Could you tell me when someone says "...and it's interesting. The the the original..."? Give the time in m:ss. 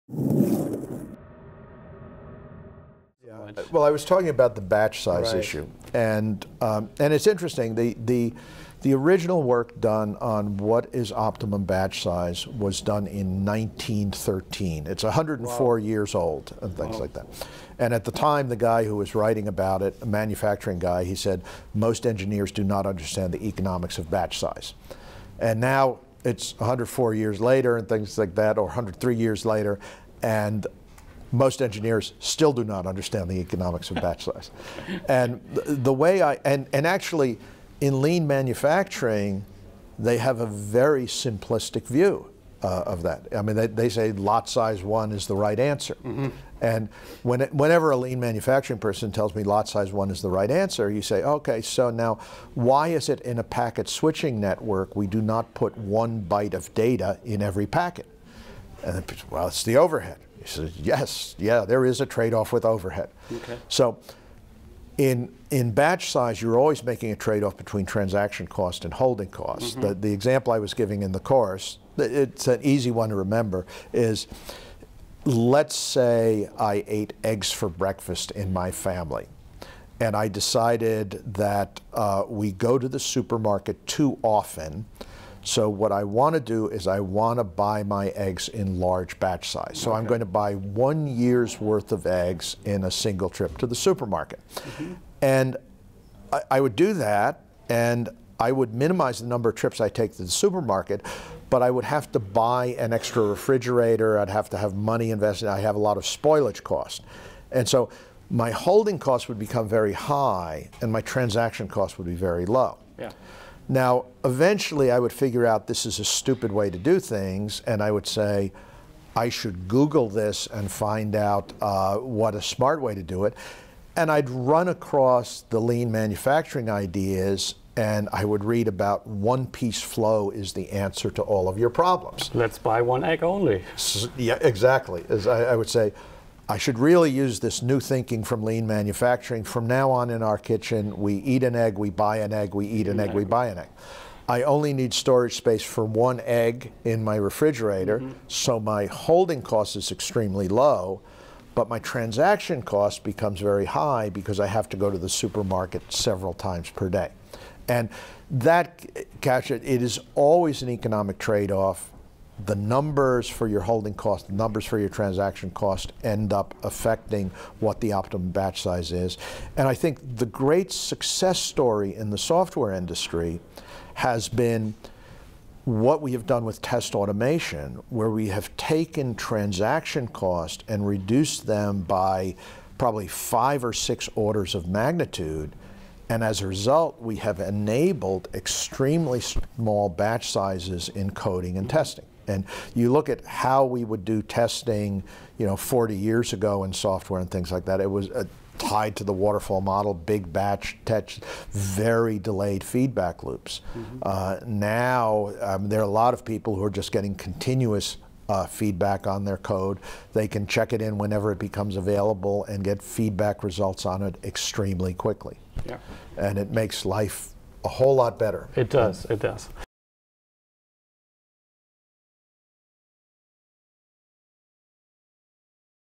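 0:06.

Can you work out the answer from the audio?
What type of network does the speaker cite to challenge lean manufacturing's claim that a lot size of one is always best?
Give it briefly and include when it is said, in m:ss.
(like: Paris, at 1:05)
packet switching network, at 0:53.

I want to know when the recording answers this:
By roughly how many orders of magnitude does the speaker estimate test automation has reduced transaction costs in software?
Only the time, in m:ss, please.
3:03.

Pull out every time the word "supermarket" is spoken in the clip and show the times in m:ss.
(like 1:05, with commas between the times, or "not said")
1:22, 1:33, 1:40, 2:35.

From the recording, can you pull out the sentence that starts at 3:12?
And you look at how we would do testing, you know, 40 years ago in software and things like that.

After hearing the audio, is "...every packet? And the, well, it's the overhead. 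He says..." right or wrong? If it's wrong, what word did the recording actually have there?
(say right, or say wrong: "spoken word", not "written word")
right.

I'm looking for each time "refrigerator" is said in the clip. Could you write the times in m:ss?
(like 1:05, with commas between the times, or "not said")
1:43, 2:27.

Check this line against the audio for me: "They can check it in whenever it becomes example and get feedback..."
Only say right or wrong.
wrong.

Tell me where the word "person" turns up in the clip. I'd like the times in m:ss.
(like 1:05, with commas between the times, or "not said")
0:48.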